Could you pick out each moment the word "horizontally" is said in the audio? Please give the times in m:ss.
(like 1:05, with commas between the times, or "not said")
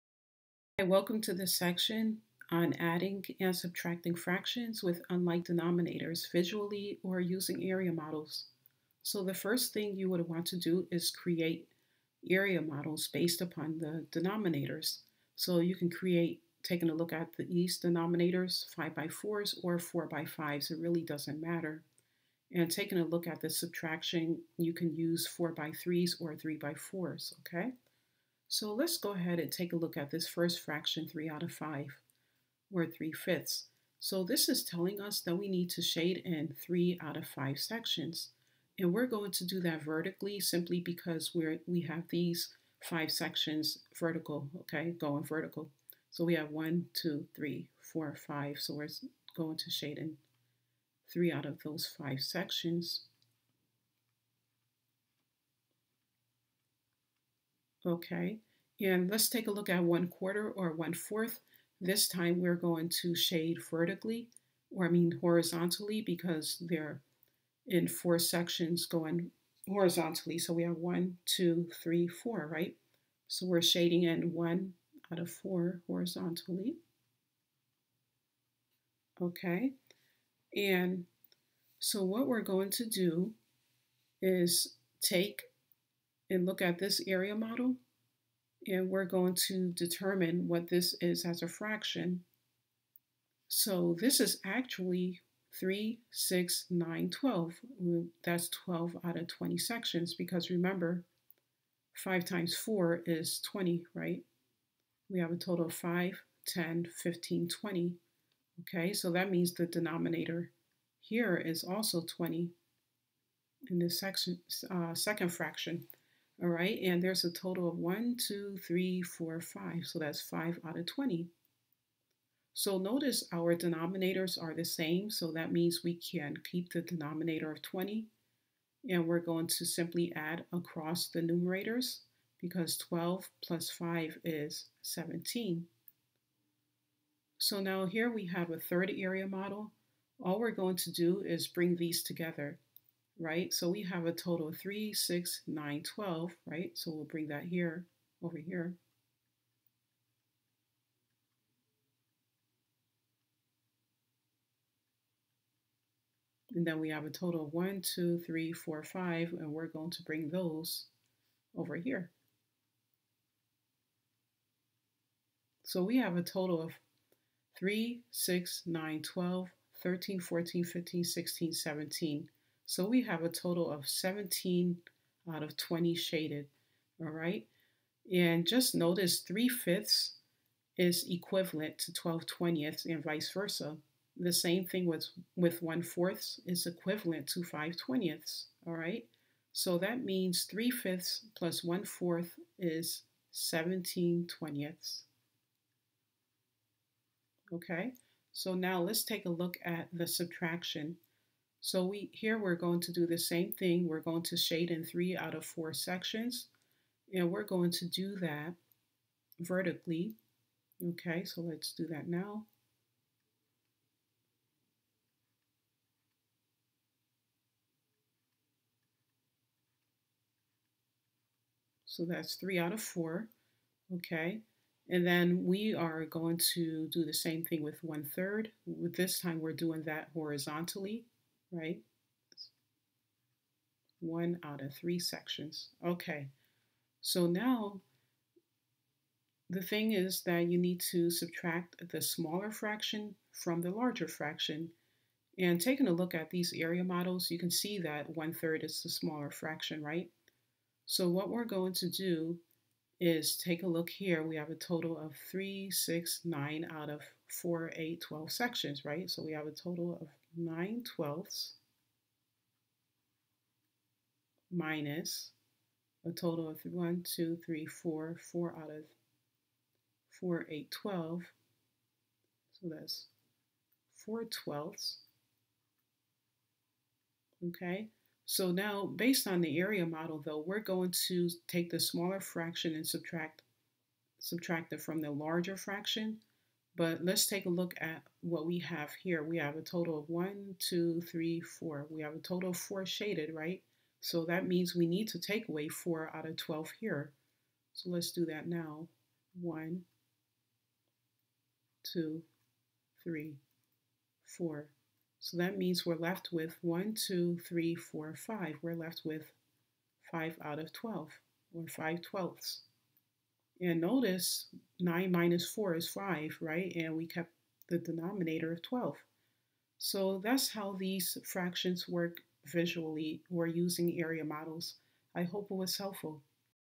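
1:05, 1:09, 1:15, 3:50.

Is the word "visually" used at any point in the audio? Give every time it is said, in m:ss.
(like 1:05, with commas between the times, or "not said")
0:06, 5:22.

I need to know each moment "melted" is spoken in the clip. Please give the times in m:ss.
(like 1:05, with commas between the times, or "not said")
not said.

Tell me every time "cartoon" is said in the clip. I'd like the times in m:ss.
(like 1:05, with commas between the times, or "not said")
not said.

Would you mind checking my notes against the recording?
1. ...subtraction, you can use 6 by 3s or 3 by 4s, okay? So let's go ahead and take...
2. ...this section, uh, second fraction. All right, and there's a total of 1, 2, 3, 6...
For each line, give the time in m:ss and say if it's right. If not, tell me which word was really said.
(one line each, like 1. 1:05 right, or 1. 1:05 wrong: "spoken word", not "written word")
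1. 0:23 wrong: "4", not "6"
2. 1:53 wrong: "4", not "6".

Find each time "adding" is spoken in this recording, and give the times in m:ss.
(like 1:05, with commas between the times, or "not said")
0:02.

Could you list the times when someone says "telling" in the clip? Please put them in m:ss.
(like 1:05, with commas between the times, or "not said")
0:34.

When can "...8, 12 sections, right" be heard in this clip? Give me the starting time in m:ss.
4:17.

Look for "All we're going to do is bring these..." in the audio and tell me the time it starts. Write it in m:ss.
2:20.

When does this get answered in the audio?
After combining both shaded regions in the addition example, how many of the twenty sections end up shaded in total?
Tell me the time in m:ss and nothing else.
2:53.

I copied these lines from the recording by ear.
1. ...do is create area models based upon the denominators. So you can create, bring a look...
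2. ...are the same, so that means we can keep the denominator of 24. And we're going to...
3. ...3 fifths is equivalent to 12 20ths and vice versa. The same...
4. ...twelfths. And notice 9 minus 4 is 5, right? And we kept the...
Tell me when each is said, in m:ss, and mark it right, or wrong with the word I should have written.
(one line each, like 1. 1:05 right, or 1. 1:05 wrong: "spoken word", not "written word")
1. 0:10 wrong: "taking", not "bring"
2. 2:04 wrong: "20", not "24"
3. 2:59 right
4. 5:12 right.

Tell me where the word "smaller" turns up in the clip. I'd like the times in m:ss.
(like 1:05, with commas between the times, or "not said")
4:02, 4:08, 4:41.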